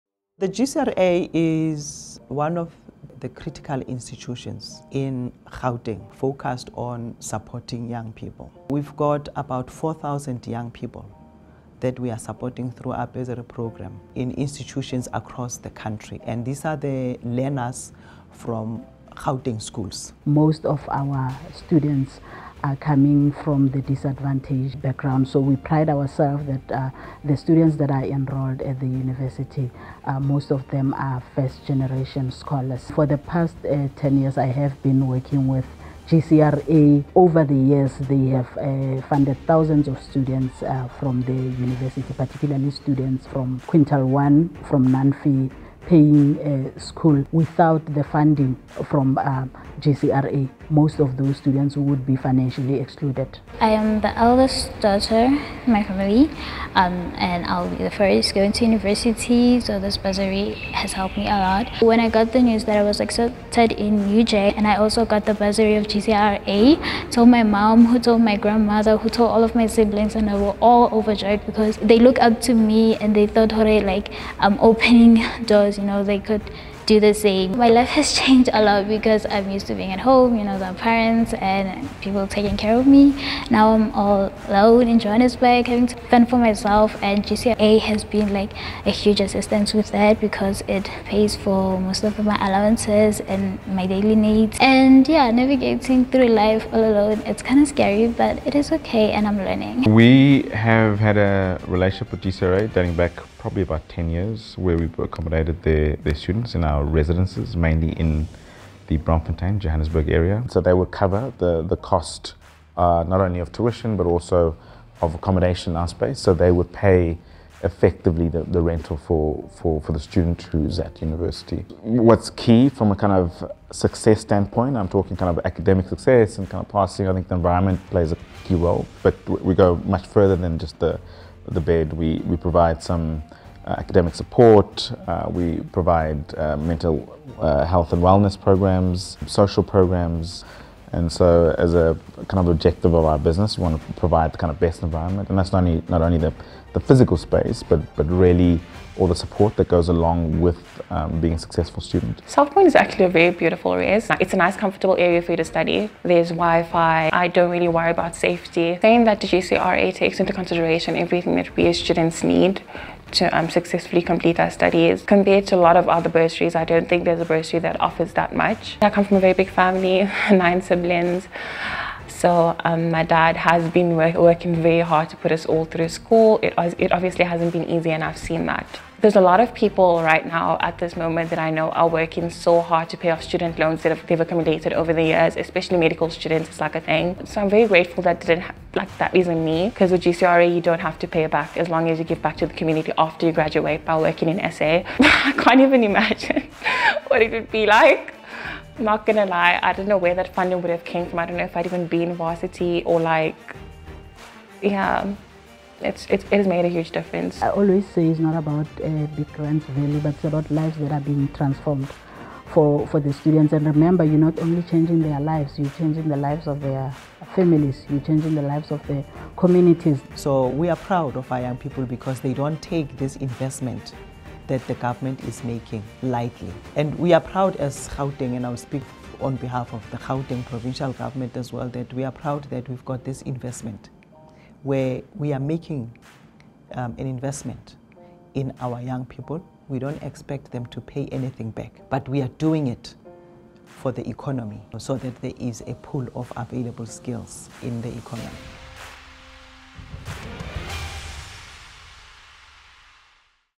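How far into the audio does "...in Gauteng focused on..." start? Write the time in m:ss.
0:04.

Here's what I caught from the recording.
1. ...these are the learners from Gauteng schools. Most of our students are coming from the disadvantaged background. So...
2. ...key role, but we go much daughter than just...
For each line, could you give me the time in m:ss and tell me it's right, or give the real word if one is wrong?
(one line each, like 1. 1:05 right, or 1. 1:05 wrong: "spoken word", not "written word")
1. 0:16 right
2. 2:08 wrong: "further", not "daughter".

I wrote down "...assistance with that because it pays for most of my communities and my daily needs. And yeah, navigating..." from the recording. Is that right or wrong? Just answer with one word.
wrong.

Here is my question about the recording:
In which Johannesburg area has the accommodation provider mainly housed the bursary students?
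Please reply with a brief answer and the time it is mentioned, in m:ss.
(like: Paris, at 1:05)
Braamfontein, at 1:48.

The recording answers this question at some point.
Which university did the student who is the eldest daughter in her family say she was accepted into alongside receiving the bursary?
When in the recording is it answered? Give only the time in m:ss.
1:03.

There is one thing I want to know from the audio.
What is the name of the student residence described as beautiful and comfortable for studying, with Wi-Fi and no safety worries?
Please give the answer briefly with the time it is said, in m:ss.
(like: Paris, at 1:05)
South Point, at 2:32.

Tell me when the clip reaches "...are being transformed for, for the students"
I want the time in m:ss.
3:30.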